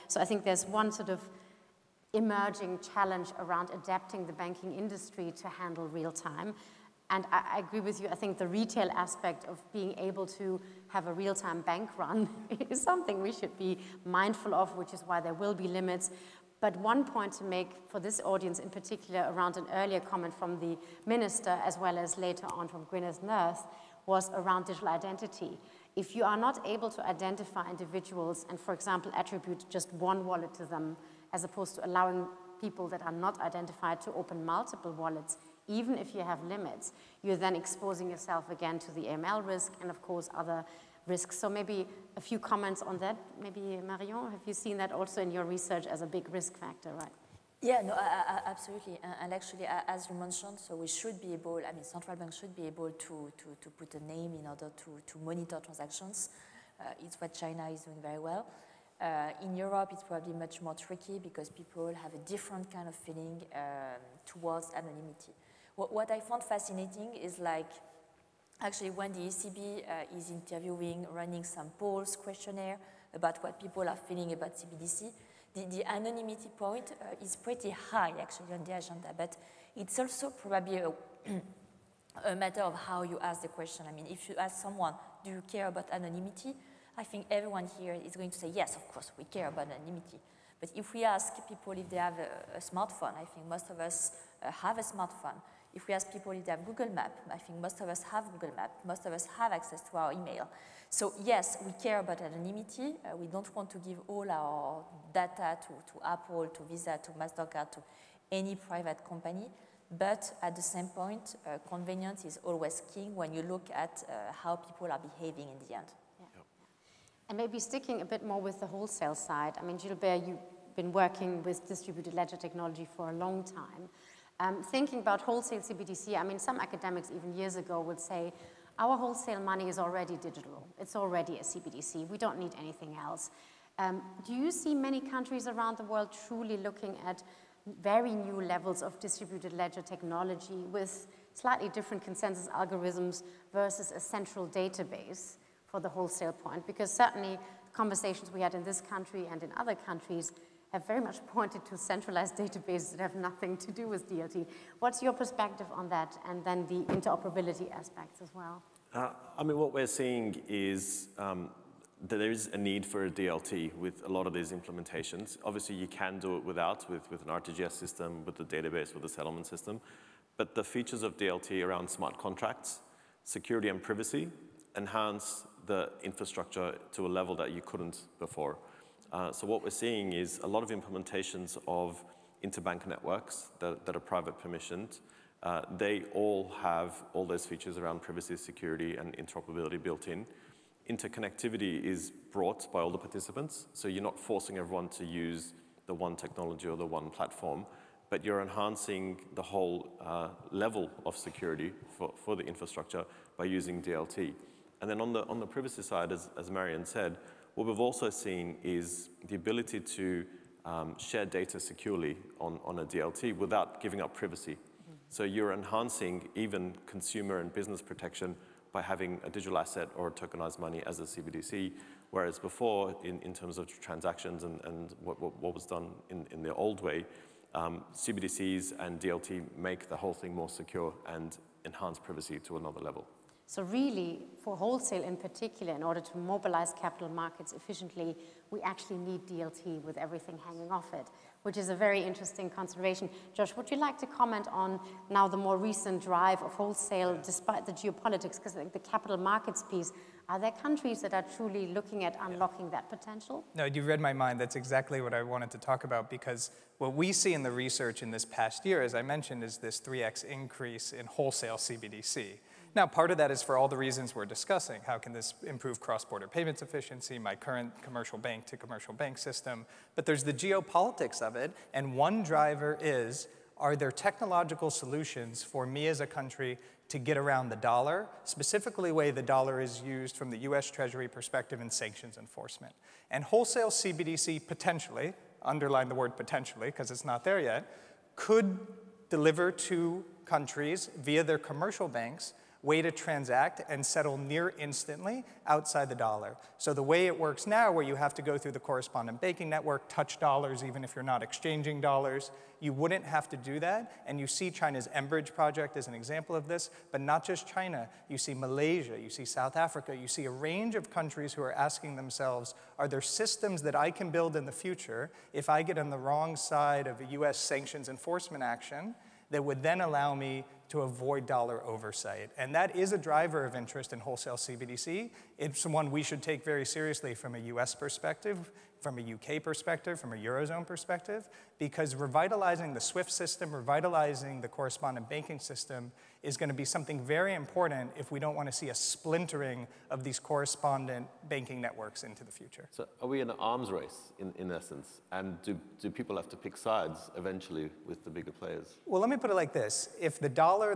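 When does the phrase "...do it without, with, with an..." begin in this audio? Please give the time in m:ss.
2:46.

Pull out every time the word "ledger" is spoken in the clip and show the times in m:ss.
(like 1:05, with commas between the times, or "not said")
2:02, 2:19.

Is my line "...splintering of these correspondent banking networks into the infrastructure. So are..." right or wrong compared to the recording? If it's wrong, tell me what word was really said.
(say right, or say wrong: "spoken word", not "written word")
wrong: "future", not "infrastructure".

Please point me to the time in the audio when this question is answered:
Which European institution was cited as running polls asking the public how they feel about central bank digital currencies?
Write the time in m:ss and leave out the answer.
1:09.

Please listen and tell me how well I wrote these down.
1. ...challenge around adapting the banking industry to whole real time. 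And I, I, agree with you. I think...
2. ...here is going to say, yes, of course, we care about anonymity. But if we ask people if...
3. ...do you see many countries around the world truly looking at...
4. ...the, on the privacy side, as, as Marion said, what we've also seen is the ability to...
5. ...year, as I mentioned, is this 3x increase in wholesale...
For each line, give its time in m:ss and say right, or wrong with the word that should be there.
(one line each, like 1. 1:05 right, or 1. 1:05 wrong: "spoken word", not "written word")
1. 0:02 wrong: "handle", not "whole"
2. 1:27 right
3. 2:14 right
4. 3:25 right
5. 4:18 right.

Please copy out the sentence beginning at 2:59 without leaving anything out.
Uh, so what we're seeing is a lot of implementations of interbank networks that, that are private permissioned.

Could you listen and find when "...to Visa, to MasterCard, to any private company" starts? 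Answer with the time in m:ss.
1:46.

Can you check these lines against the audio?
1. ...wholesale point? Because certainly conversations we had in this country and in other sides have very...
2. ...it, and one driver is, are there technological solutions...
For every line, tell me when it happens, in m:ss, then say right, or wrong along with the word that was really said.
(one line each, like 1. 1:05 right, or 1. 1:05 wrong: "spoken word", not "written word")
1. 2:25 wrong: "countries", not "sides"
2. 4:31 right.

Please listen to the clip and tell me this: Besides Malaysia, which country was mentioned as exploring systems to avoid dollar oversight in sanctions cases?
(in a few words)
South Africa.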